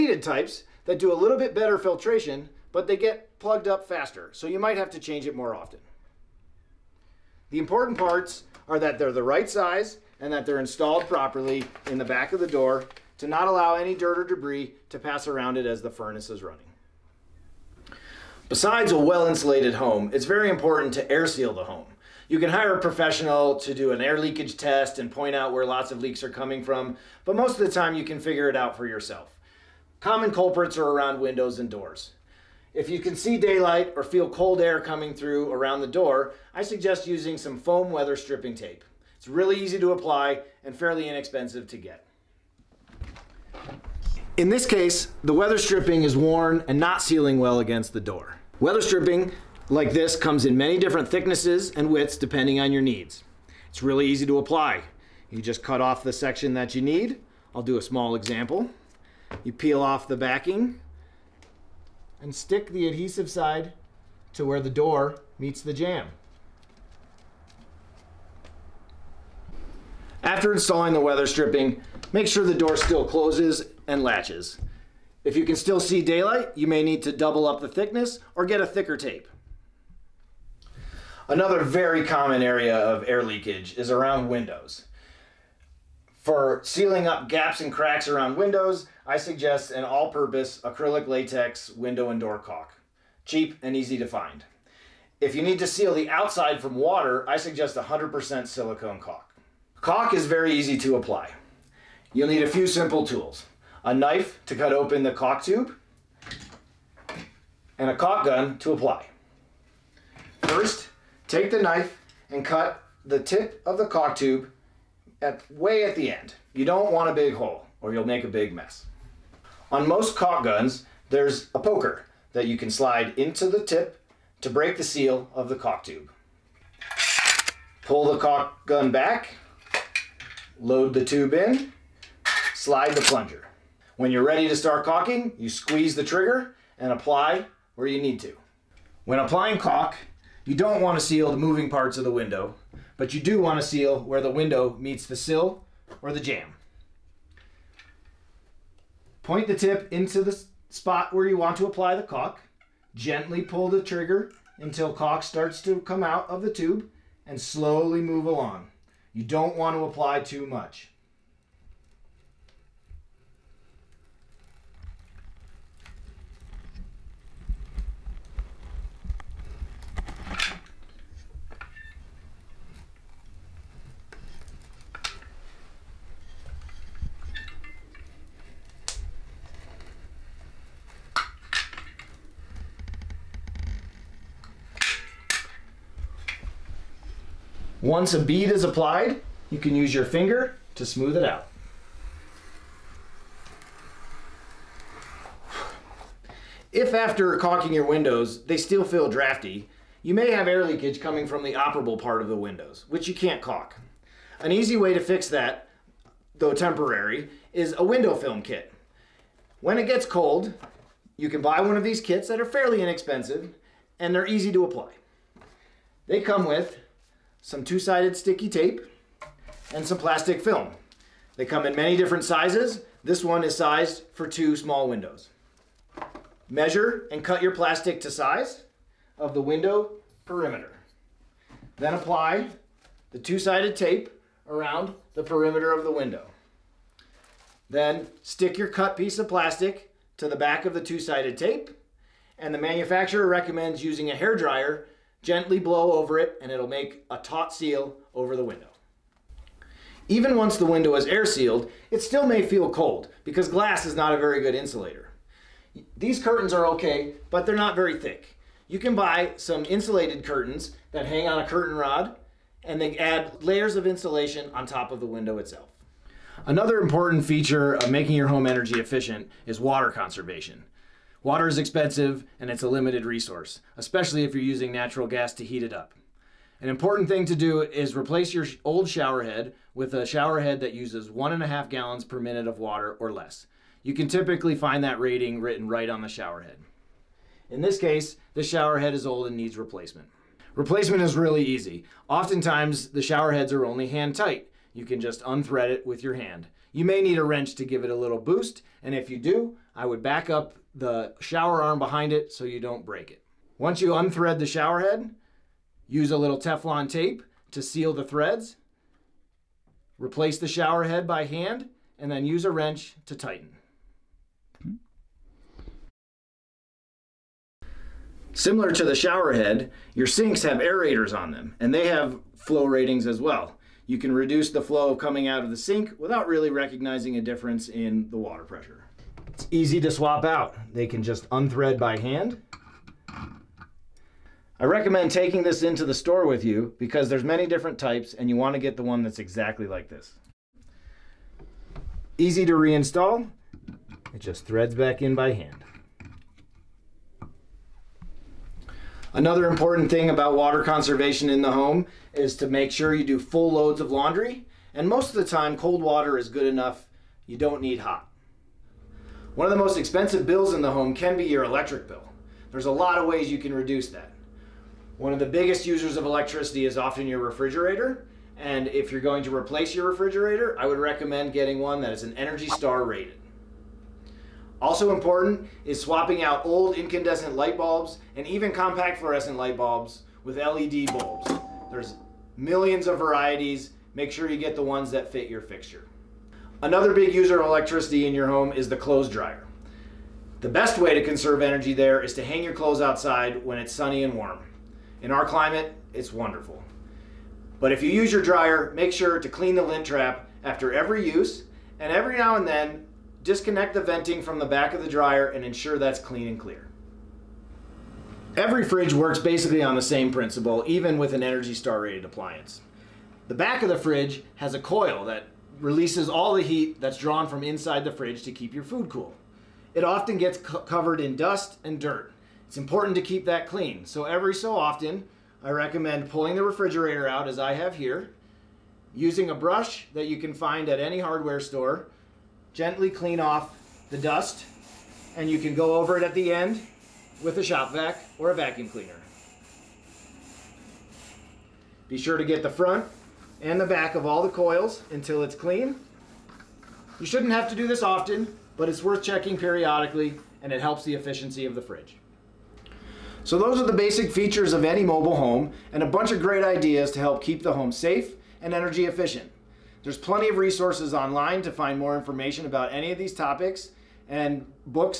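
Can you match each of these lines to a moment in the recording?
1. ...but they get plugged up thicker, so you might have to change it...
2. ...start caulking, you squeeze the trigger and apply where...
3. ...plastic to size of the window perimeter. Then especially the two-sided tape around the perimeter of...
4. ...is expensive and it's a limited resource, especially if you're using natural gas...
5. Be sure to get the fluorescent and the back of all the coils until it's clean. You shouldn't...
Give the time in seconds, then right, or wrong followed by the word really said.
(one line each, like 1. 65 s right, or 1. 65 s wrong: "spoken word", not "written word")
1. 2 s wrong: "faster", not "thicker"
2. 134 s right
3. 227 s wrong: "apply", not "especially"
4. 271 s right
5. 441 s wrong: "front", not "fluorescent".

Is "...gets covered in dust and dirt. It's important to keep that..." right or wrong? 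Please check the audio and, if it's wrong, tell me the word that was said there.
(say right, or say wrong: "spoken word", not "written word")
right.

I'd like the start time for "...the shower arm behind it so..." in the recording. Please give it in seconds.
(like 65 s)
300 s.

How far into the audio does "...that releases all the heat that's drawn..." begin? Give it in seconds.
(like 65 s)
415 s.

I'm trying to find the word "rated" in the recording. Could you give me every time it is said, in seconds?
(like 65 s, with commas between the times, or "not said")
372 s, 411 s.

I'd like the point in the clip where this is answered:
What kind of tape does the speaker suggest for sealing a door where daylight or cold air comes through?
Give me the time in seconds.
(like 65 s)
37 s.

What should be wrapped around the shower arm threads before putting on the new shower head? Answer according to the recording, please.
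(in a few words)
Teflon tape.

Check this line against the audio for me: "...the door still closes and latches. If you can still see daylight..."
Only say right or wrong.
right.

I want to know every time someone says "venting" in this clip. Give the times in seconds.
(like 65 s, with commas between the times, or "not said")
403 s.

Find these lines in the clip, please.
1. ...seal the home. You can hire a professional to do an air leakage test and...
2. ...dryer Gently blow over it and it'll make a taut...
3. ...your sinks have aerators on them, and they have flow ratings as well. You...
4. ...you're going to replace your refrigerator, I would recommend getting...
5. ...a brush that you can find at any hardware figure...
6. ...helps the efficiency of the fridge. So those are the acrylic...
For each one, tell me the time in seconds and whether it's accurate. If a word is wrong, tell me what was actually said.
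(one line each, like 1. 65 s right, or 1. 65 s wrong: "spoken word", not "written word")
1. 21 s right
2. 244 s right
3. 319 s right
4. 368 s right
5. 429 s wrong: "store", not "figure"
6. 450 s wrong: "basic", not "acrylic".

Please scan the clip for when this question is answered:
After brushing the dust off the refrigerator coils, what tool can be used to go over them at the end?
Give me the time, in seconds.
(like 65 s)
437 s.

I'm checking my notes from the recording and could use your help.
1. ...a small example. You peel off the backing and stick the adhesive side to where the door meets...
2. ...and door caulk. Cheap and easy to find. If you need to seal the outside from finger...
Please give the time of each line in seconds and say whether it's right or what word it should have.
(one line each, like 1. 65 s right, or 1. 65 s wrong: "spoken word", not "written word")
1. 57 s right
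2. 92 s wrong: "water", not "finger".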